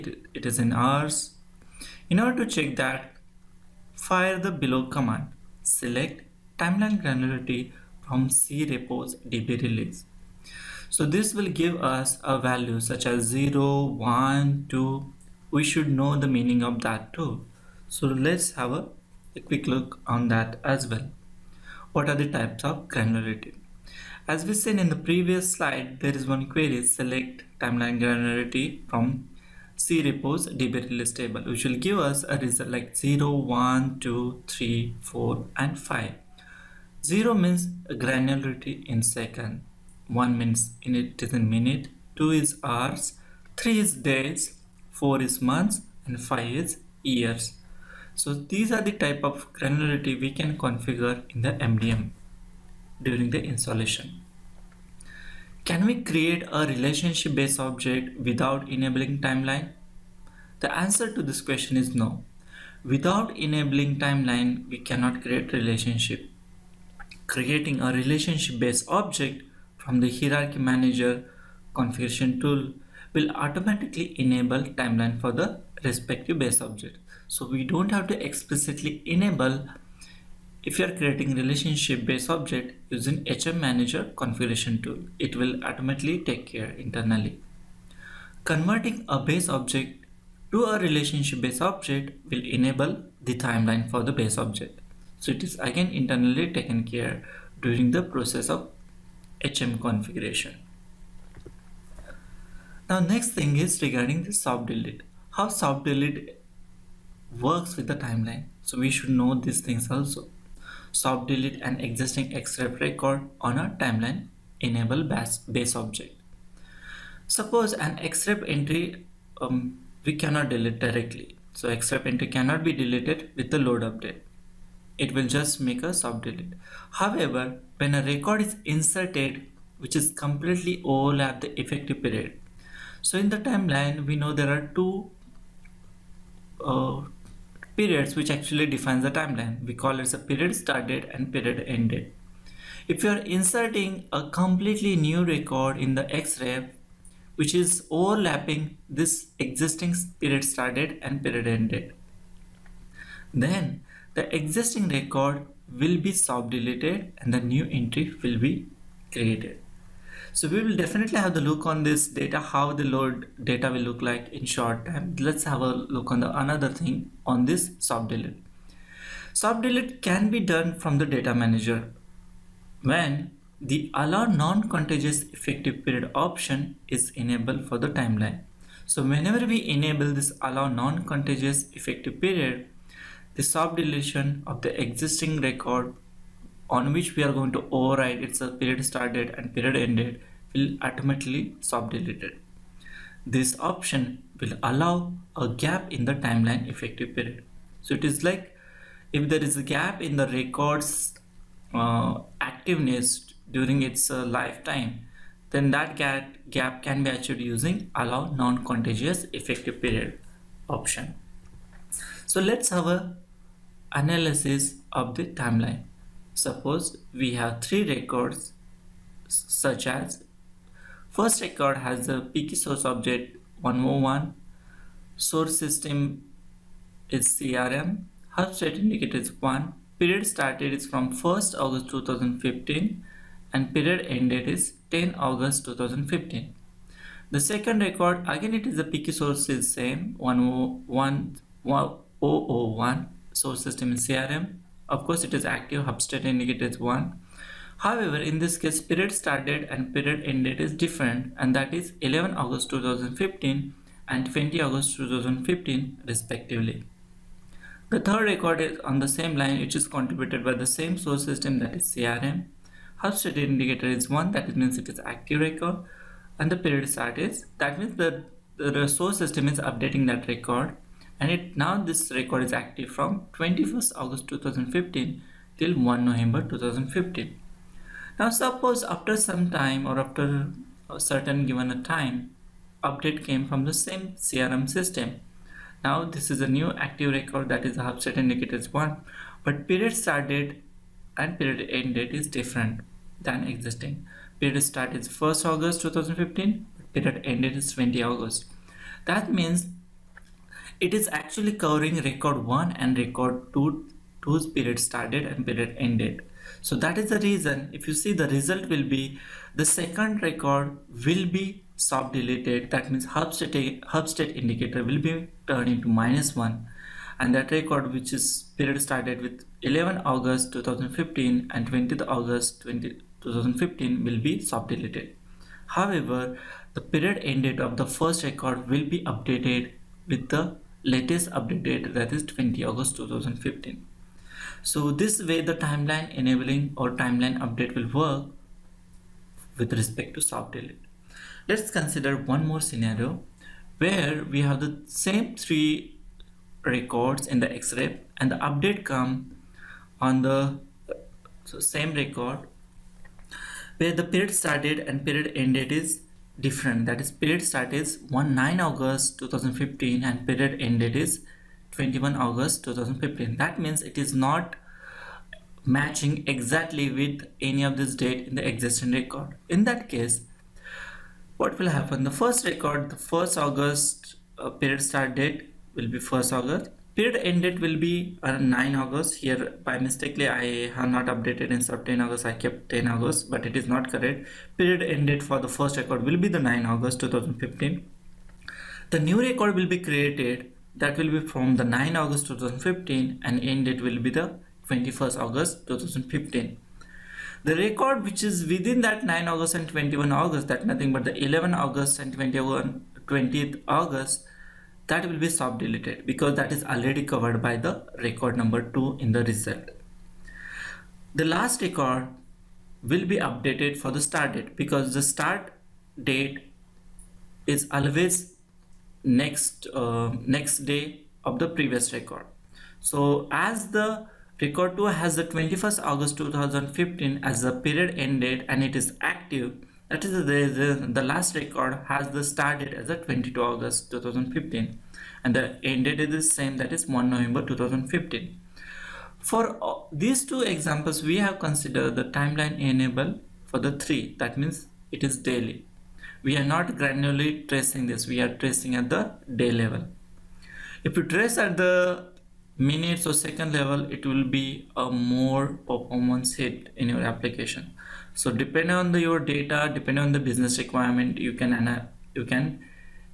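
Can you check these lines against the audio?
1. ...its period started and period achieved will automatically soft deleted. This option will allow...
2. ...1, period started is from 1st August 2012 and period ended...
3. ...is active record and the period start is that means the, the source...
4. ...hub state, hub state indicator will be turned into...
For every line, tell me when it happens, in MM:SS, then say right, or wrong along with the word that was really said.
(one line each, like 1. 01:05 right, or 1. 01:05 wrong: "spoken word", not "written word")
1. 03:08 wrong: "ended", not "achieved"
2. 03:49 wrong: "2015", not "2012"
3. 04:24 right
4. 05:13 right.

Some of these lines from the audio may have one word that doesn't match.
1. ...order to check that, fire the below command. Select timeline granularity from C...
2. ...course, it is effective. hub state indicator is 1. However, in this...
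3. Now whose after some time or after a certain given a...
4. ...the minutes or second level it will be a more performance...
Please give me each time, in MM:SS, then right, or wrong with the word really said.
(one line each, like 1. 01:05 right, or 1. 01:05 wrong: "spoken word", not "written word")
1. 00:02 right
2. 04:05 wrong: "active", not "effective"
3. 04:38 wrong: "suppose", not "whose"
4. 07:31 right.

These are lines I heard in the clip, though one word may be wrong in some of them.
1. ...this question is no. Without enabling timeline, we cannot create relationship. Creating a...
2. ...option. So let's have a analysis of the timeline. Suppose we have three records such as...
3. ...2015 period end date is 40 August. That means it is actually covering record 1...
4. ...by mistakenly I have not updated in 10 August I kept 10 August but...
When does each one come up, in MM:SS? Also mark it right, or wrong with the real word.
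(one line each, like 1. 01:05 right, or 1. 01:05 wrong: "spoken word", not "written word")
1. 01:01 right
2. 03:30 right
3. 04:55 wrong: "20", not "40"
4. 06:19 right.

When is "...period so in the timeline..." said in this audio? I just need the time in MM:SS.
02:12.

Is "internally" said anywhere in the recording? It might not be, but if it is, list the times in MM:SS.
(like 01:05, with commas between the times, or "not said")
01:26, 01:35.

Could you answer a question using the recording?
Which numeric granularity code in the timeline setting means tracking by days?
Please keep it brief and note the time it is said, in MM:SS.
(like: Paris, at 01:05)
3, at 00:43.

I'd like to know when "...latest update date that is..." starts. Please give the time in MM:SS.
05:30.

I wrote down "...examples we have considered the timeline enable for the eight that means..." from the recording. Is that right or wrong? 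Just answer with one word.
wrong.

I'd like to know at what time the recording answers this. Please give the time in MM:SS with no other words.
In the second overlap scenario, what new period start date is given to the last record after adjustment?
07:12.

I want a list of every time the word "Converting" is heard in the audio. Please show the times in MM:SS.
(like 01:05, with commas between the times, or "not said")
01:28.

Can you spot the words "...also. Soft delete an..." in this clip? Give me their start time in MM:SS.
01:49.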